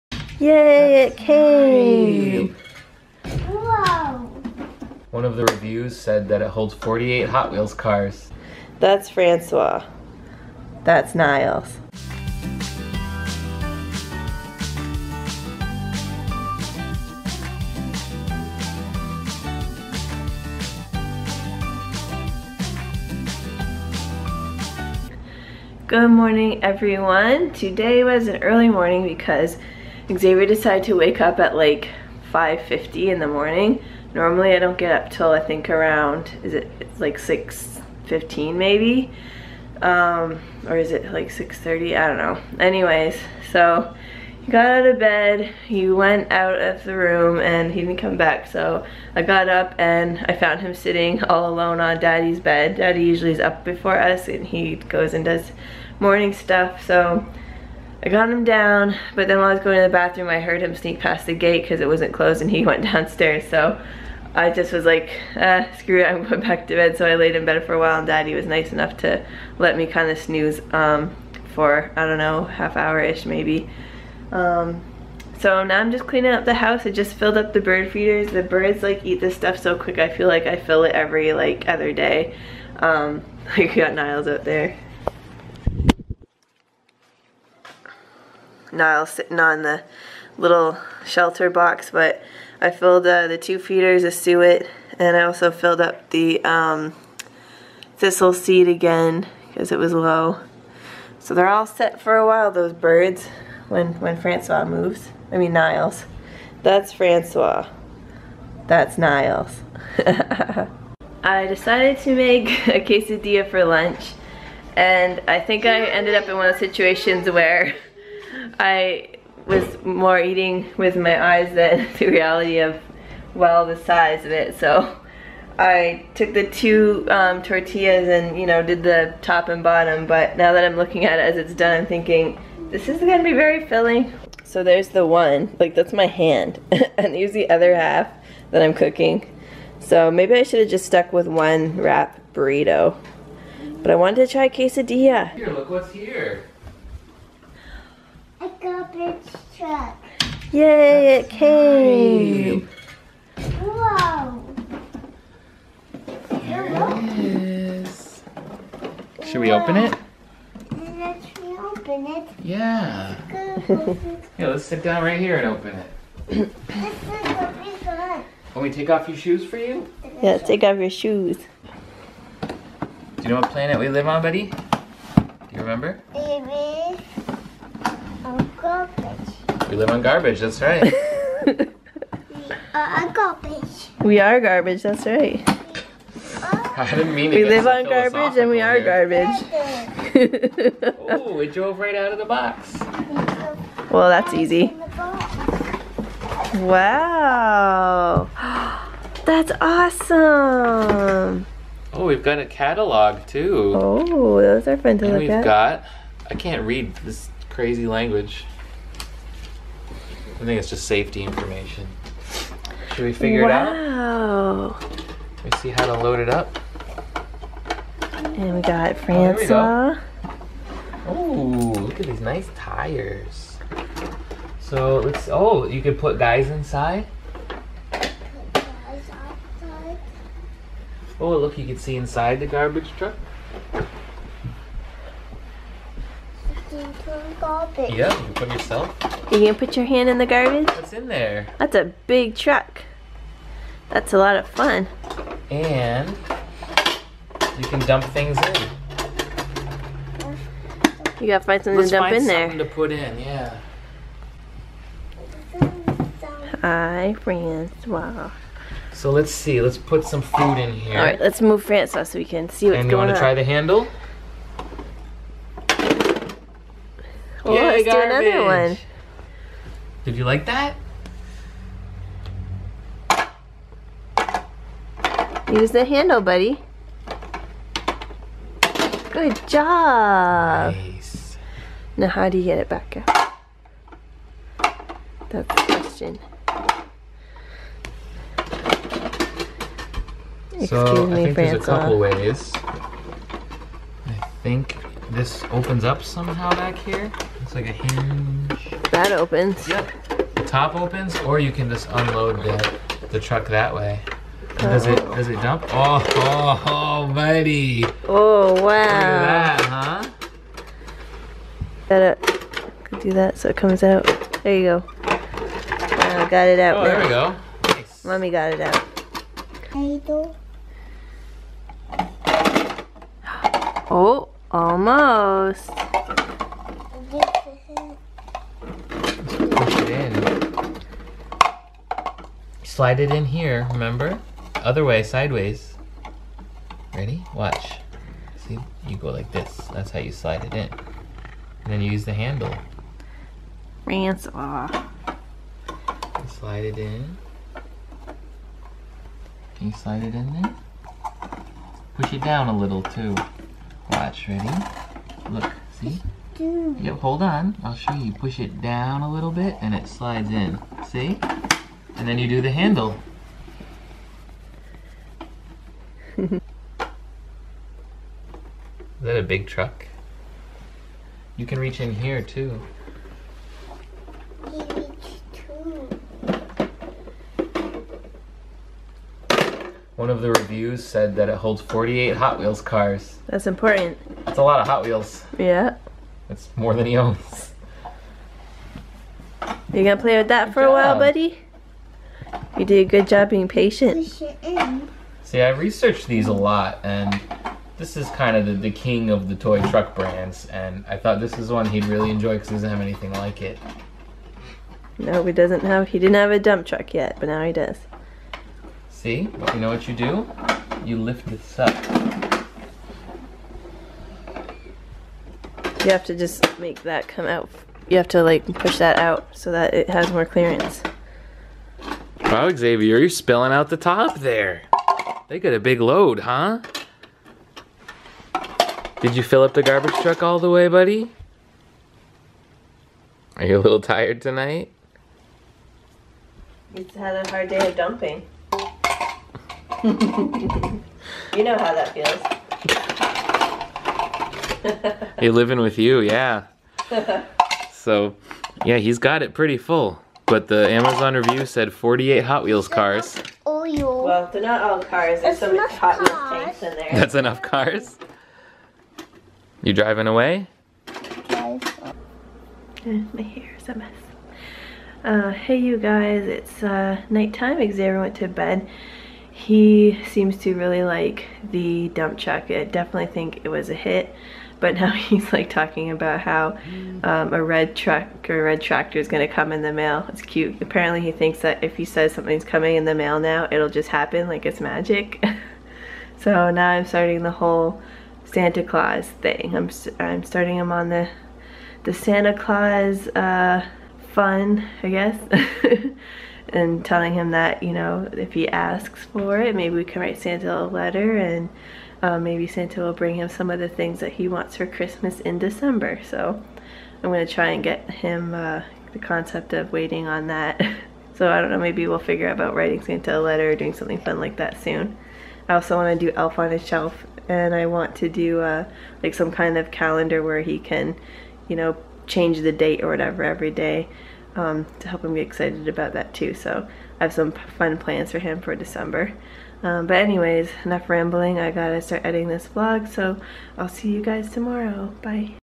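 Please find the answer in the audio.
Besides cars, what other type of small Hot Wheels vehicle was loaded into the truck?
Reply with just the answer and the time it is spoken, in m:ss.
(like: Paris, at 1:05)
tanks, at 7:36.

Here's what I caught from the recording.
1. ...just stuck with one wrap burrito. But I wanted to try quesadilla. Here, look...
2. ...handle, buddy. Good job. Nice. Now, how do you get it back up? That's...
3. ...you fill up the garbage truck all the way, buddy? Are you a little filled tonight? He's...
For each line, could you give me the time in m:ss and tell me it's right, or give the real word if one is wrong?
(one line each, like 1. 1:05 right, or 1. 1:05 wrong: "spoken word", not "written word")
1. 2:20 right
2. 4:35 right
3. 7:09 wrong: "tired", not "filled".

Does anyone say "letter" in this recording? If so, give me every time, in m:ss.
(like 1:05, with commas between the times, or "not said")
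8:20, 8:33.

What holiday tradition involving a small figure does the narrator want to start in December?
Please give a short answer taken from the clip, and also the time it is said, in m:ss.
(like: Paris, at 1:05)
Elf on a Shelf, at 8:36.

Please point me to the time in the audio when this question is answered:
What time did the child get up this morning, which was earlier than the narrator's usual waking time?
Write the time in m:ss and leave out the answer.
0:32.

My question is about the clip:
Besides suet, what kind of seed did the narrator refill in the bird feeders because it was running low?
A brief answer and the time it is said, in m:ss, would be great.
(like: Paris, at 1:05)
thistle seed, at 1:37.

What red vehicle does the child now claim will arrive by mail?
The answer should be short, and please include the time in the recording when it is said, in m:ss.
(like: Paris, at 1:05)
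red tractor, at 7:58.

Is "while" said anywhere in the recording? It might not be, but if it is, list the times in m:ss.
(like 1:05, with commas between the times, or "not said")
0:59, 1:07, 1:42, 6:30.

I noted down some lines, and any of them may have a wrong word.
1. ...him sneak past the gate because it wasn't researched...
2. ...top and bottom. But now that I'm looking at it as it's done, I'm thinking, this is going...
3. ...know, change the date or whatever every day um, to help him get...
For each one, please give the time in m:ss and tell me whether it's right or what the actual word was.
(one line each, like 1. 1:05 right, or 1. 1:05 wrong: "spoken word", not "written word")
1. 1:00 wrong: "closed", not "researched"
2. 2:09 right
3. 8:41 right.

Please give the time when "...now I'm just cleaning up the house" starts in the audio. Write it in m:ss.
1:15.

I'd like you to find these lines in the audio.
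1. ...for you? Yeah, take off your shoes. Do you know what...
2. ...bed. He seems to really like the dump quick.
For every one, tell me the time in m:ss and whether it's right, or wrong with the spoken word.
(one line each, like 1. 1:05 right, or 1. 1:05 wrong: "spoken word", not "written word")
1. 2:49 right
2. 7:48 wrong: "truck", not "quick".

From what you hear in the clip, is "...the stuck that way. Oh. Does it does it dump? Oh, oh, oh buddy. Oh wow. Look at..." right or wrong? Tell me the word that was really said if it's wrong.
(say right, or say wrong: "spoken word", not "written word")
wrong: "truck", not "stuck".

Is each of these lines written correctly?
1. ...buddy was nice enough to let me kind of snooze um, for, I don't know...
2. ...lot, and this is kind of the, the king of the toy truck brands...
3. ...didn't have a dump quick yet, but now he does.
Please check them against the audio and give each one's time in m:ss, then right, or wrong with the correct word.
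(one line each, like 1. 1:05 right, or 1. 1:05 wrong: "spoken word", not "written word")
1. 1:08 wrong: "daddy", not "buddy"
2. 6:36 right
3. 6:45 wrong: "truck", not "quick".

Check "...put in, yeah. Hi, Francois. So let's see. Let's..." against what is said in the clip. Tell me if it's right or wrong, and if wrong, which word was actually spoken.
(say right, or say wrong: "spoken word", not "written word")
right.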